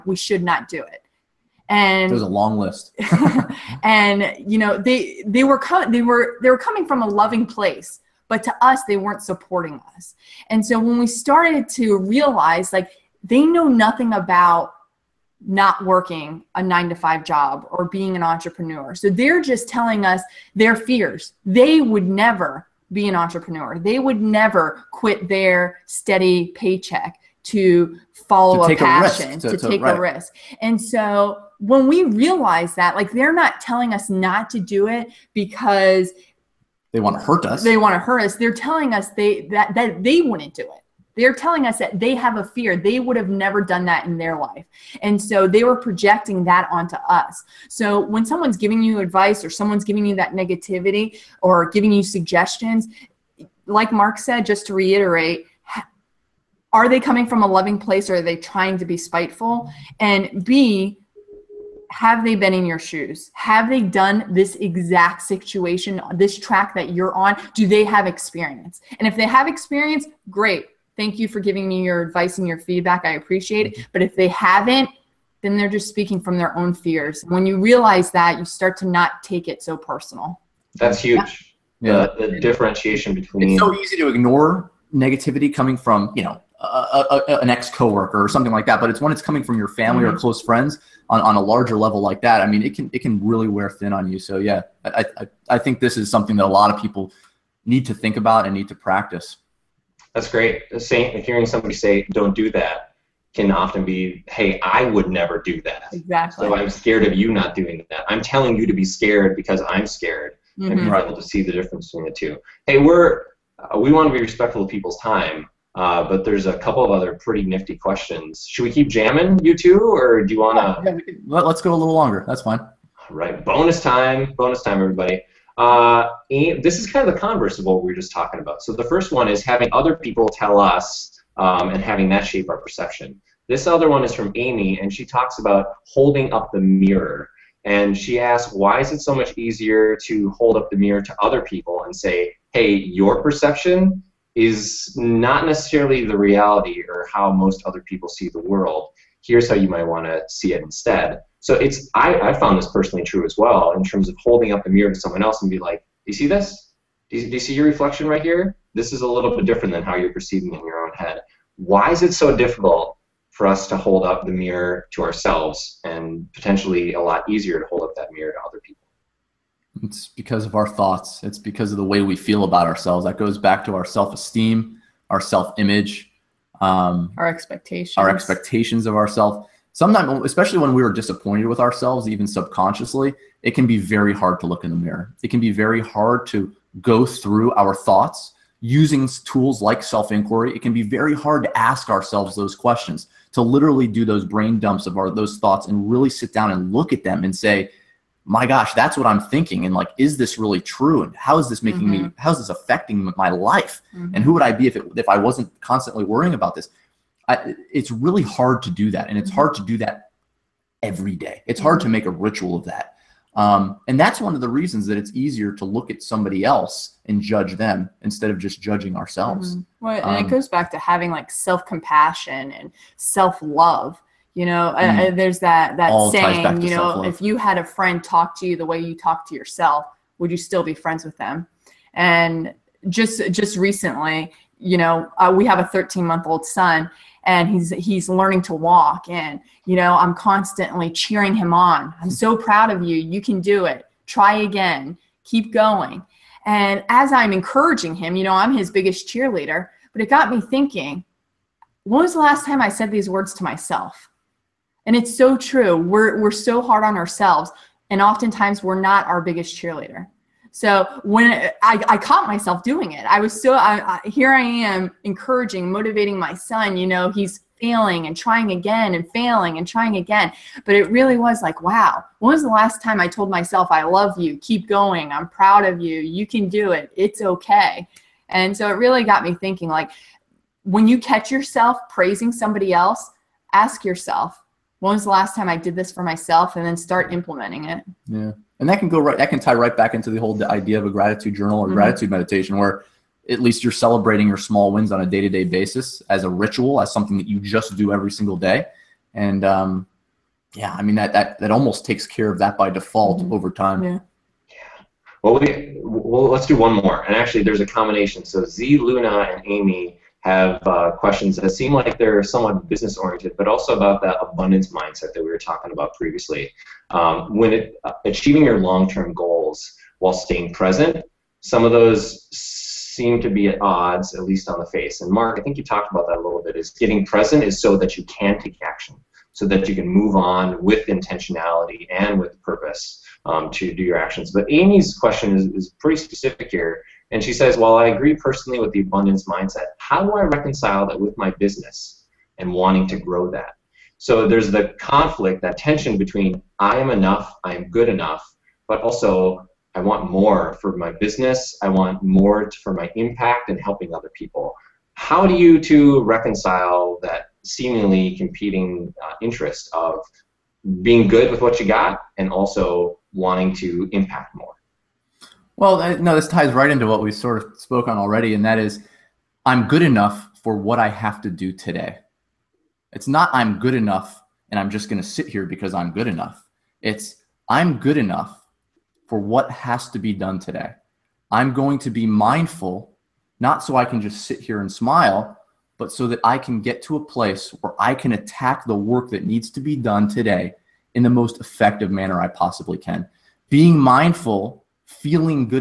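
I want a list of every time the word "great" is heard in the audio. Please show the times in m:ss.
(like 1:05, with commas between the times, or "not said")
1:10, 1:40.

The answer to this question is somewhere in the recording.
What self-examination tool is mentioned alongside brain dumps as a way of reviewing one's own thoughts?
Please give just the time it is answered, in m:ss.
3:09.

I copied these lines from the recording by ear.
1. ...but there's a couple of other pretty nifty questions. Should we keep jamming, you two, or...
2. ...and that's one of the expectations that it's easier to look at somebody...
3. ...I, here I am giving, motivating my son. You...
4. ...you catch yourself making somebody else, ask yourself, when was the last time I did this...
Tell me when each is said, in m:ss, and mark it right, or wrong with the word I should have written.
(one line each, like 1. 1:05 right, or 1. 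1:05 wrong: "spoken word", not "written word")
1. 1:56 right
2. 3:33 wrong: "reasons", not "expectations"
3. 4:24 wrong: "encouraging", not "giving"
4. 4:40 wrong: "praising", not "making".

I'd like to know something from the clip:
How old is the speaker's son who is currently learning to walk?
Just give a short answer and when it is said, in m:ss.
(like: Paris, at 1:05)
13 months, at 3:55.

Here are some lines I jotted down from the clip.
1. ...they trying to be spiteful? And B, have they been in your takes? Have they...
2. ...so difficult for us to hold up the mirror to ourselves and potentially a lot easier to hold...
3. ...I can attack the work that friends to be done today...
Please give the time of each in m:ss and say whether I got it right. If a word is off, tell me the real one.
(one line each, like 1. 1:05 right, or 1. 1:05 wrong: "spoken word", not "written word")
1. 0:58 wrong: "shoes", not "takes"
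2. 2:42 right
3. 6:27 wrong: "needs", not "friends".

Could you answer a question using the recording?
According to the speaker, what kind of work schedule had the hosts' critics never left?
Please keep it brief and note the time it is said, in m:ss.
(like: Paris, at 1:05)
Nine to five, at 0:16.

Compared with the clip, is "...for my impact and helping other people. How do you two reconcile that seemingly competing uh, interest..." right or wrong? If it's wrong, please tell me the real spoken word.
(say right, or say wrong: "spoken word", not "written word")
right.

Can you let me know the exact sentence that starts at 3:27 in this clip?
I, it's really hard to do that.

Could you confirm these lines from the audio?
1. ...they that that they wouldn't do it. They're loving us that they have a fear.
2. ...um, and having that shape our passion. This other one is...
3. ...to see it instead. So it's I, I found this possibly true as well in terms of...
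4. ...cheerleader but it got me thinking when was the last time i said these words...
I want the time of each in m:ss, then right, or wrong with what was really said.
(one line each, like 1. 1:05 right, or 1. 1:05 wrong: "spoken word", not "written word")
1. 0:39 wrong: "telling", not "loving"
2. 2:11 wrong: "perception", not "passion"
3. 2:30 wrong: "personally", not "possibly"
4. 4:09 right.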